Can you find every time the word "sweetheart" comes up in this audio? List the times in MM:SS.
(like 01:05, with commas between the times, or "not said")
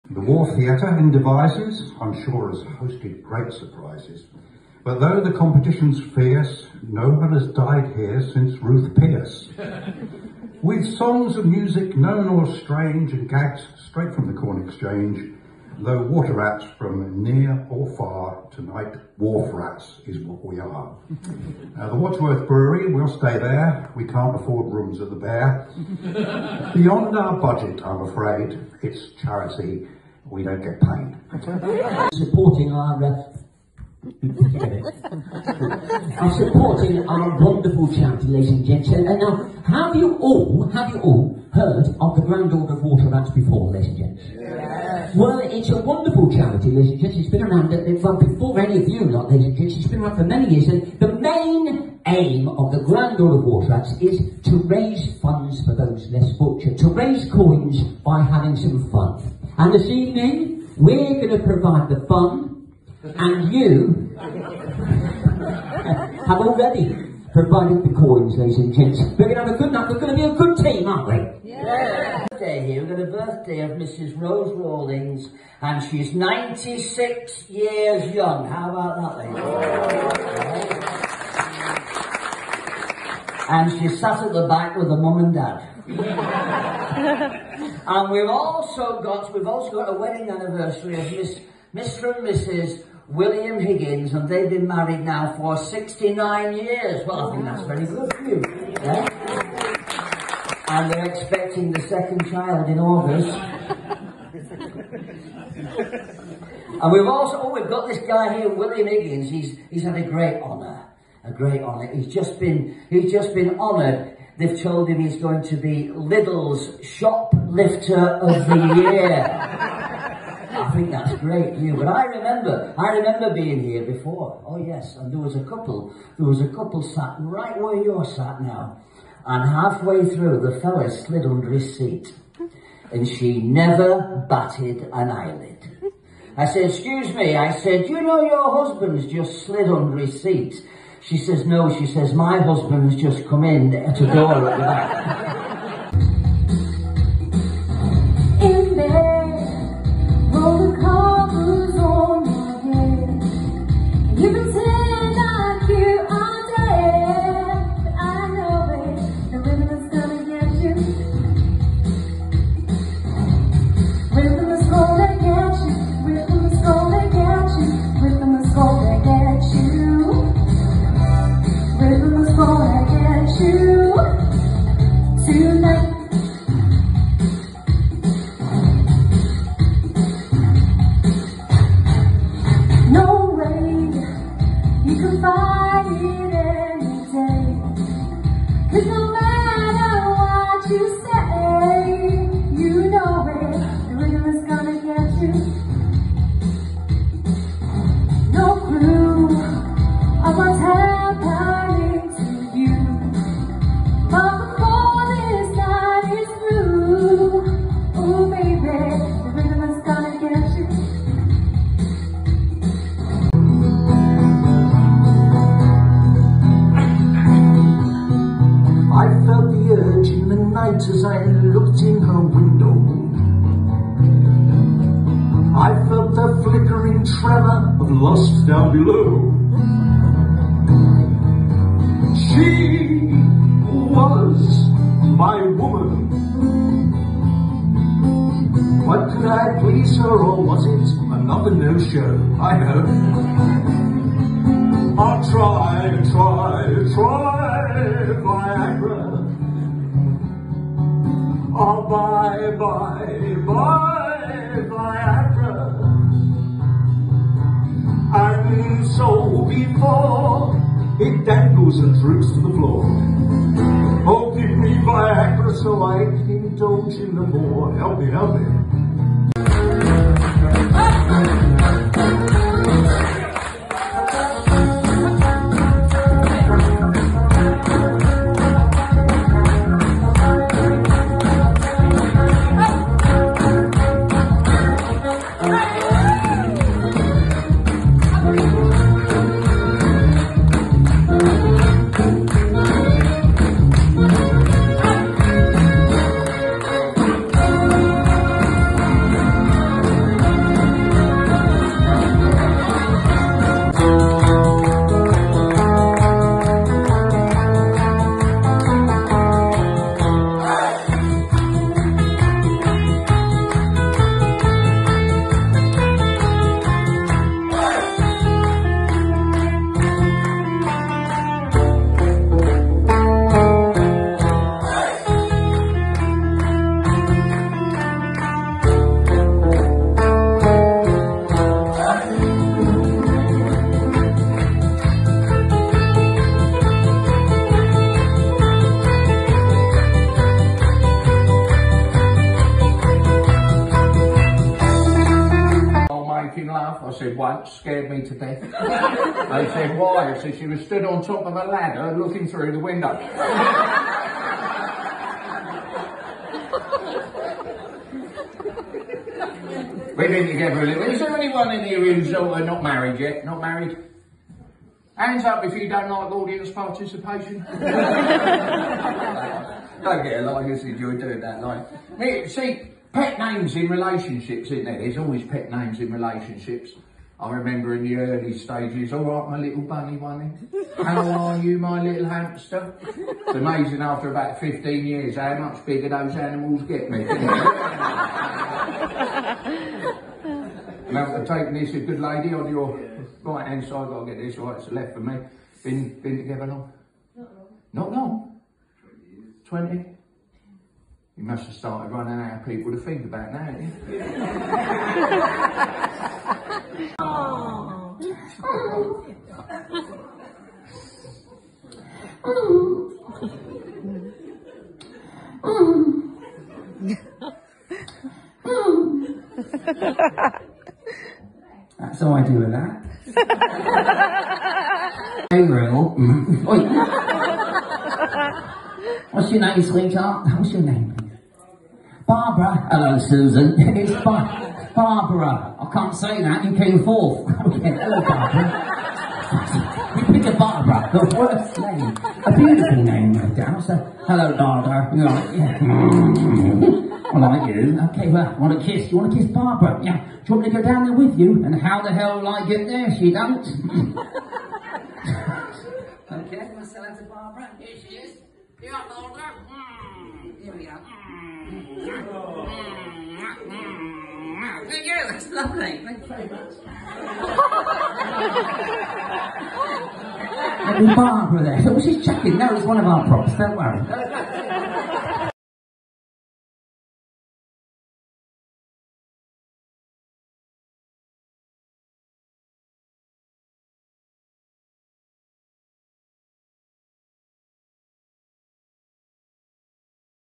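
07:09.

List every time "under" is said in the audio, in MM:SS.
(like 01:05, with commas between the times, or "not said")
02:11, 02:19.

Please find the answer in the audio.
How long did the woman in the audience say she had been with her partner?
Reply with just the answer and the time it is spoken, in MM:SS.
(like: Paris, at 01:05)
20 years, at 06:39.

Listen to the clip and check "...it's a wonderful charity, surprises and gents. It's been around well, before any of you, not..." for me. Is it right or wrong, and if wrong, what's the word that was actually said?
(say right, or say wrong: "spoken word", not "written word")
wrong: "ladies", not "surprises".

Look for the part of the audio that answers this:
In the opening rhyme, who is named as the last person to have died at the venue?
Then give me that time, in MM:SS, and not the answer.
00:08.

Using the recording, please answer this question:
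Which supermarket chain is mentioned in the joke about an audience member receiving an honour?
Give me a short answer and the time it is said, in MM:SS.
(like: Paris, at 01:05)
Lidl, at 01:55.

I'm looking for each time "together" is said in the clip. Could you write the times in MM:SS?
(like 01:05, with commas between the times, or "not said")
06:00, 06:36.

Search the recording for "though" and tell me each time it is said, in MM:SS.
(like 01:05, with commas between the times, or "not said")
00:04, 00:15.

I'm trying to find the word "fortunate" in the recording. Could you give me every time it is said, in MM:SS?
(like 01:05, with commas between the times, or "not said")
00:56.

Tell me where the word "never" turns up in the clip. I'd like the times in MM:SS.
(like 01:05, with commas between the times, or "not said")
02:13.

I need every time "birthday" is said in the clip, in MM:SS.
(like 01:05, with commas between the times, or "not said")
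01:13.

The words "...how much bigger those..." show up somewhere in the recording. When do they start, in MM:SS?
06:25.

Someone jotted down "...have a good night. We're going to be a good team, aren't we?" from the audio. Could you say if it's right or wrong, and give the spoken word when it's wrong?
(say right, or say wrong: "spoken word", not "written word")
right.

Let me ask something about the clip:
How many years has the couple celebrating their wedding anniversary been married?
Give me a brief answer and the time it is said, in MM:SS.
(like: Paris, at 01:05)
69, at 01:35.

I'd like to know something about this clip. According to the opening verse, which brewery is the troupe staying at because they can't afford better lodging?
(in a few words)
Wadworth Brewery.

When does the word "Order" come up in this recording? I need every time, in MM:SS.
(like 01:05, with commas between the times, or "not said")
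00:42, 00:53.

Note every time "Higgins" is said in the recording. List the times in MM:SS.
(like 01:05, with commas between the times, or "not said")
01:33, 01:48.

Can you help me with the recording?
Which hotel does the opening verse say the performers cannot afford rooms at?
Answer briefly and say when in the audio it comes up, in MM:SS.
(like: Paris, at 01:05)
the Bear, at 00:25.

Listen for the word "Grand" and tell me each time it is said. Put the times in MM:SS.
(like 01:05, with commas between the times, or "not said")
00:42, 00:52.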